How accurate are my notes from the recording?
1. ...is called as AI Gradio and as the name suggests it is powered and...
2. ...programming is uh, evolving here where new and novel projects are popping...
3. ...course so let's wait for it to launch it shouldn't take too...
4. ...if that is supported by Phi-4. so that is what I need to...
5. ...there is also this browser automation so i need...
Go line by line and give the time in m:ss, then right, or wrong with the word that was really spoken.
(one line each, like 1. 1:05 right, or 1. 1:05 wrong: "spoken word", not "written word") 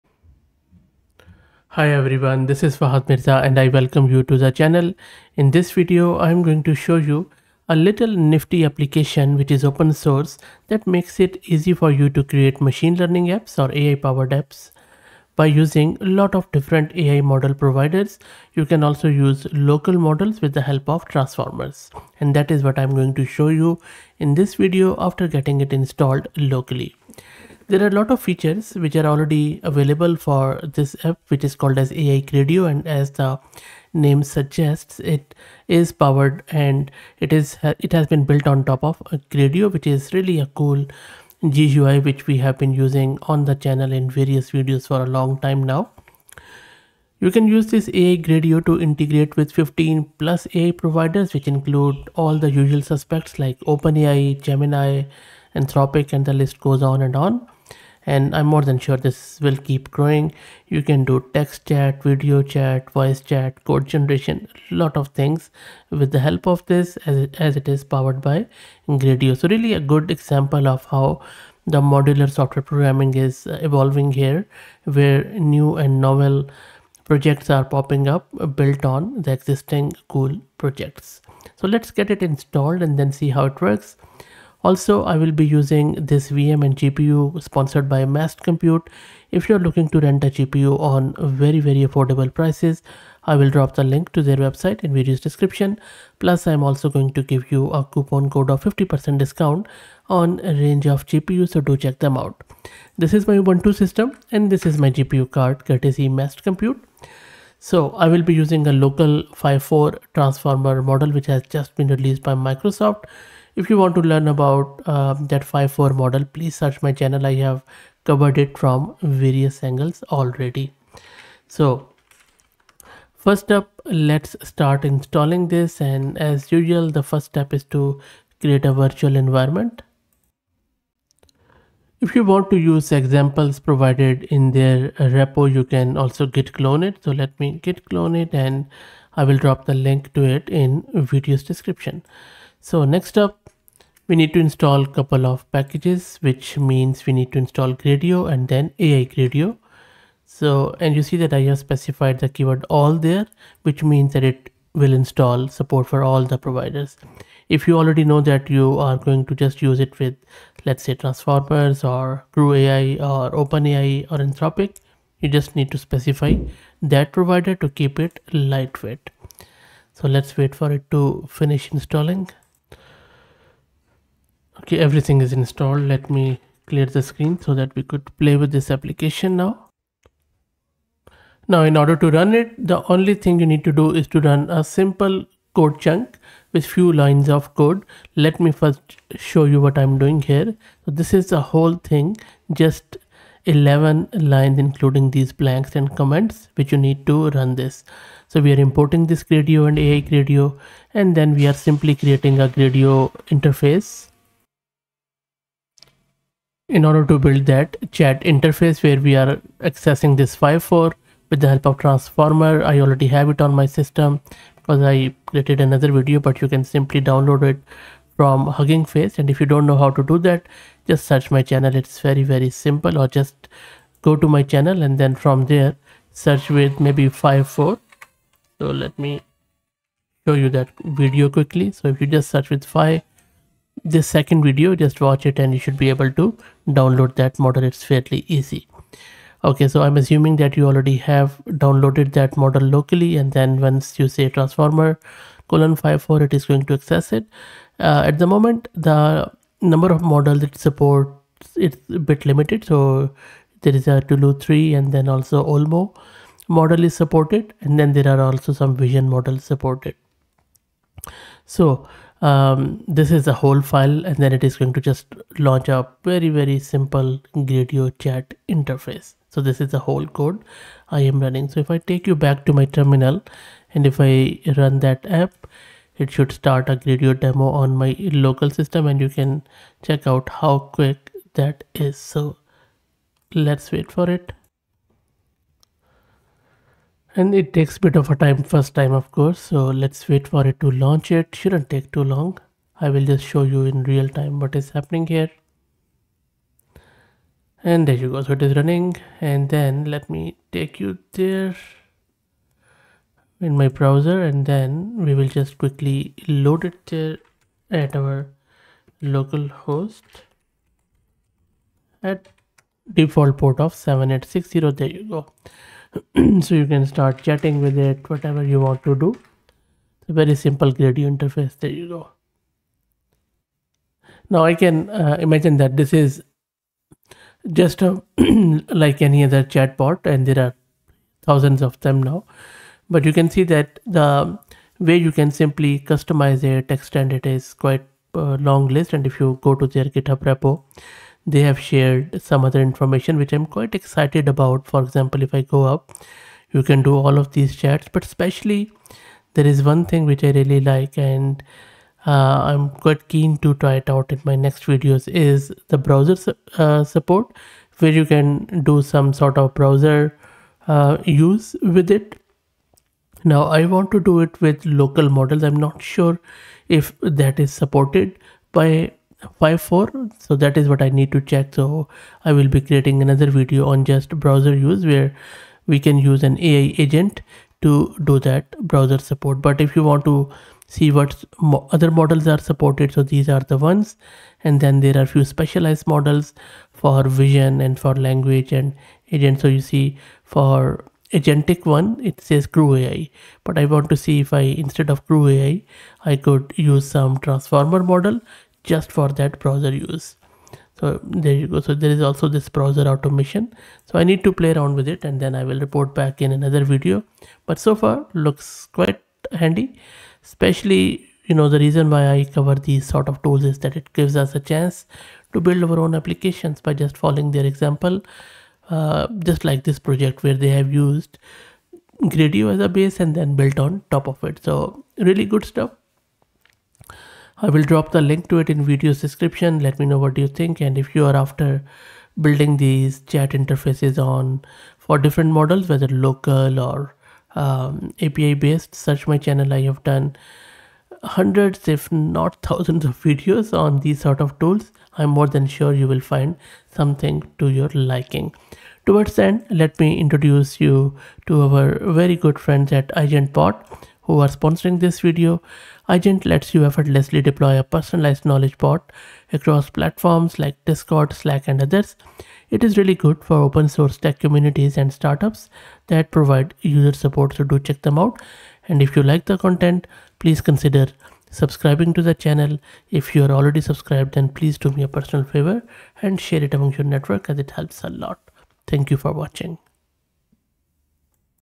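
1. 0:31 right
2. 1:12 right
3. 4:49 right
4. 6:06 right
5. 6:41 right.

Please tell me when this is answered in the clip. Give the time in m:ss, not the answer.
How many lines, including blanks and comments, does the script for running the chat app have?
3:13.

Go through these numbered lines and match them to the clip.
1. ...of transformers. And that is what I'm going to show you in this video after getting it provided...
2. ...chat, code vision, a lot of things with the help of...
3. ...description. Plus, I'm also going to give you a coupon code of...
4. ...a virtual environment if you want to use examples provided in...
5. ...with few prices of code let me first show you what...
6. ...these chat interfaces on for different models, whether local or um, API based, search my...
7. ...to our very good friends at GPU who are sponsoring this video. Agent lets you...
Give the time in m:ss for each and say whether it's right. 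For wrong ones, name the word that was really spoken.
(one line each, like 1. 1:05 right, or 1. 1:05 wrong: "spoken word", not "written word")
1. 0:20 wrong: "installed", not "provided"
2. 1:03 wrong: "generation", not "vision"
3. 1:35 right
4. 2:08 right
5. 3:06 wrong: "lines", not "prices"
6. 7:12 right
7. 7:31 wrong: "EigentBOT", not "GPU".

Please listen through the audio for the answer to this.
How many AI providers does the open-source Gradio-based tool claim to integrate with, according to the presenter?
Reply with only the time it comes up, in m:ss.
0:49.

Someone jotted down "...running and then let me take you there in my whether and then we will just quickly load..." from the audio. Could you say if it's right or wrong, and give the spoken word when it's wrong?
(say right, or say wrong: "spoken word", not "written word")
wrong: "browser", not "whether".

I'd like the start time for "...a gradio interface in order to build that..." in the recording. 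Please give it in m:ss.
3:22.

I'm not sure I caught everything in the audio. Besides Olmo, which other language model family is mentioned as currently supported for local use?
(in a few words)
Tulu 3.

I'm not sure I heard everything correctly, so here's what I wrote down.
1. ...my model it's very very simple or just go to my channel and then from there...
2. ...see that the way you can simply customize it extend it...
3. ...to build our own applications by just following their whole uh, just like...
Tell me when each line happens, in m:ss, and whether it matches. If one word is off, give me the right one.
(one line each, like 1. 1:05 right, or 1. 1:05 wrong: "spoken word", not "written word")
1. 3:41 wrong: "channel", not "model"
2. 5:33 right
3. 6:55 wrong: "example", not "whole".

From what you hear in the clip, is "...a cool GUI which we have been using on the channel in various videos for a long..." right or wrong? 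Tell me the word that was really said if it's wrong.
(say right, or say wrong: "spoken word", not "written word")
right.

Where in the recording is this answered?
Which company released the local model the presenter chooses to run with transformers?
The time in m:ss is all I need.
1:52.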